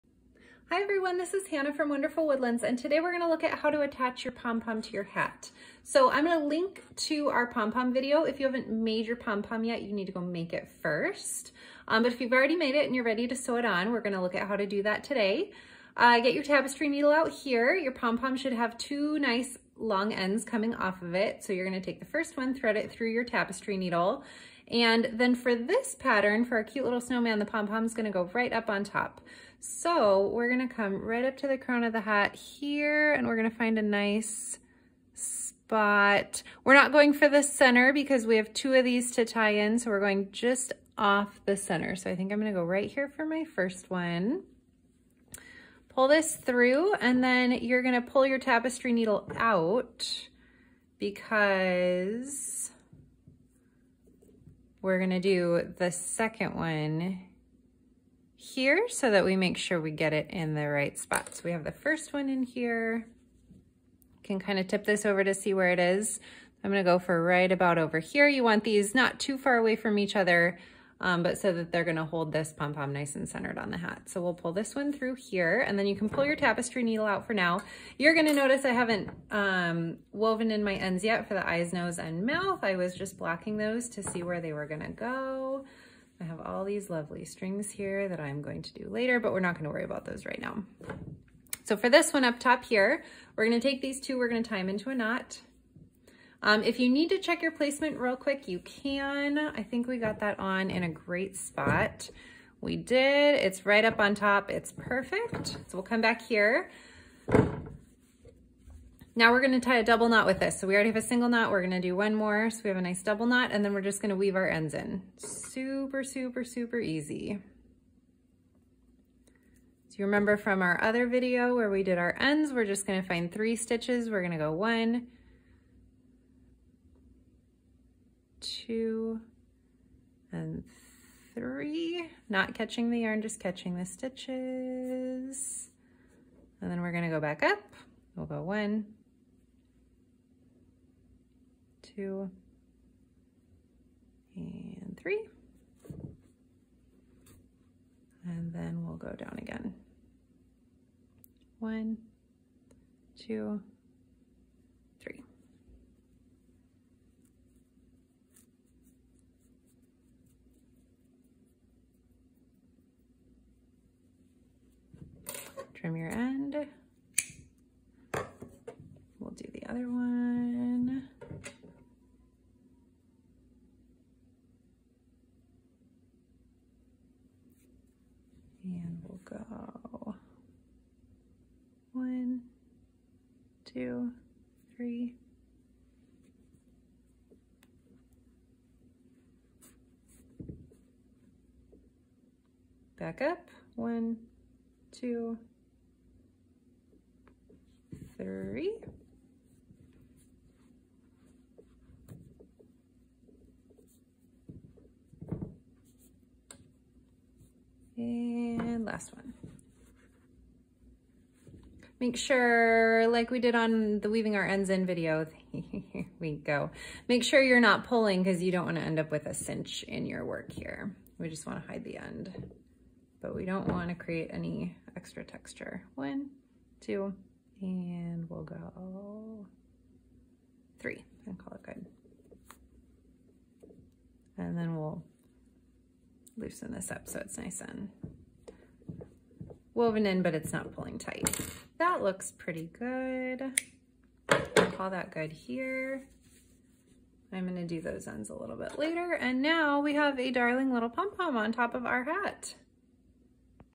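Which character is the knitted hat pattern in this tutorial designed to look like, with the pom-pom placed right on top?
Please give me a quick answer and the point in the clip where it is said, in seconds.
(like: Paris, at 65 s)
Snowman, at 27 s.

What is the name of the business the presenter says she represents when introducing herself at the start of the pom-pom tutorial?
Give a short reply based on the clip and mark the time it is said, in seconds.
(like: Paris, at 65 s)
Wonderful Woodlands, at 1 s.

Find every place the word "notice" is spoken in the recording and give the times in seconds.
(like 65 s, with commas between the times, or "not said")
78 s.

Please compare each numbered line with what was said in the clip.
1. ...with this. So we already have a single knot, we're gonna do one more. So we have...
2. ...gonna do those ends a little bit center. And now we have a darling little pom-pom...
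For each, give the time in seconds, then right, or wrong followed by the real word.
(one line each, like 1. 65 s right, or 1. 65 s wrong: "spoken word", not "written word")
1. 110 s right
2. 247 s wrong: "later", not "center".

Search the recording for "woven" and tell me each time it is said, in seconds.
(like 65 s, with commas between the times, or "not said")
80 s, 239 s.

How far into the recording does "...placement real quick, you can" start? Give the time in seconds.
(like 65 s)
97 s.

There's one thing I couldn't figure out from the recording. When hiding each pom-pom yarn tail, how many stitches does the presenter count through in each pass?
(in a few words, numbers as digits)
3.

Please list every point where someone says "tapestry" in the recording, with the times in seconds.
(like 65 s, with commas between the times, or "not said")
16 s, 23 s, 48 s, 76 s.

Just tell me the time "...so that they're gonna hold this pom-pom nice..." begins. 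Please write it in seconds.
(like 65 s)
71 s.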